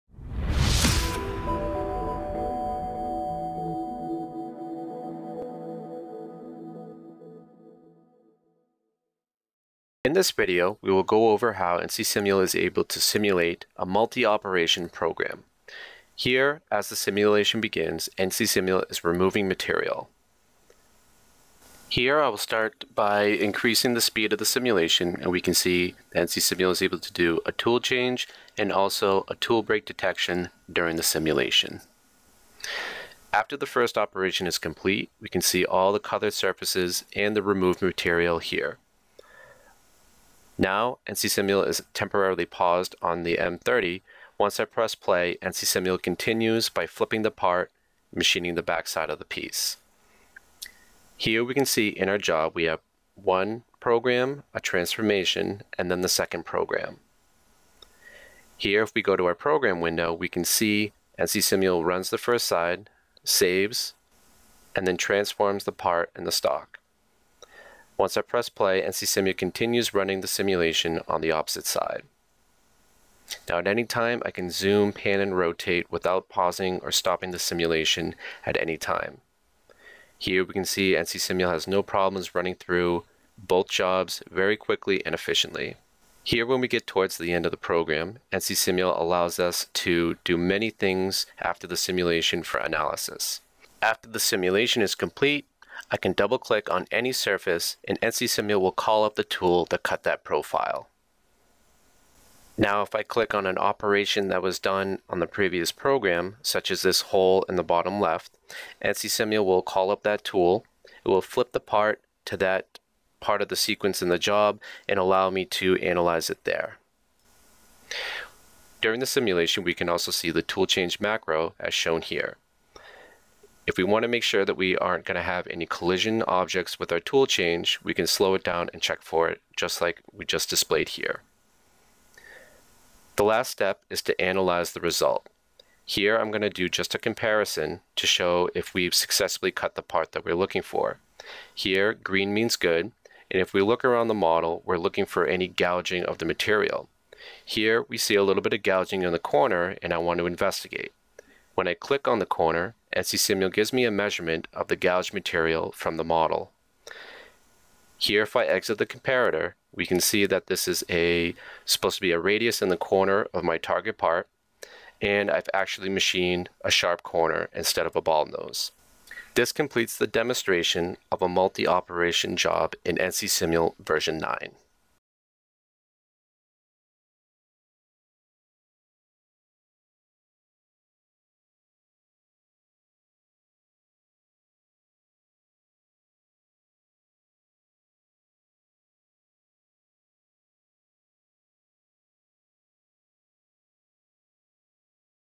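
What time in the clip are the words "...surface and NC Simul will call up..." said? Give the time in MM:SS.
01:37.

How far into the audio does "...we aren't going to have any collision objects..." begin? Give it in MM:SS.
02:04.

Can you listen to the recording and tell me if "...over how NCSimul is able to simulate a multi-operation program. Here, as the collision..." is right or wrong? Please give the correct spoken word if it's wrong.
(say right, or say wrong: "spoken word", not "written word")
wrong: "simulation", not "collision".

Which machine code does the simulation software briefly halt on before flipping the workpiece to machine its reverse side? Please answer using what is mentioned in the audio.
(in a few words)
M30.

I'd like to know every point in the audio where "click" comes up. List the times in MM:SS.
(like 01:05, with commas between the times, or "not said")
01:36, 01:43, 02:31.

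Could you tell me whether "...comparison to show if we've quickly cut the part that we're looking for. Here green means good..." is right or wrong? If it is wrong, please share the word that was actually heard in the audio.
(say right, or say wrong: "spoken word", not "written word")
wrong: "successfully", not "quickly".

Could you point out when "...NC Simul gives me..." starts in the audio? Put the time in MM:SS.
02:32.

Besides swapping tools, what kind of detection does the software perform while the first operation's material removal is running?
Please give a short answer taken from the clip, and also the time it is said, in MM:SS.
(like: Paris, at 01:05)
Tool break detection, at 00:29.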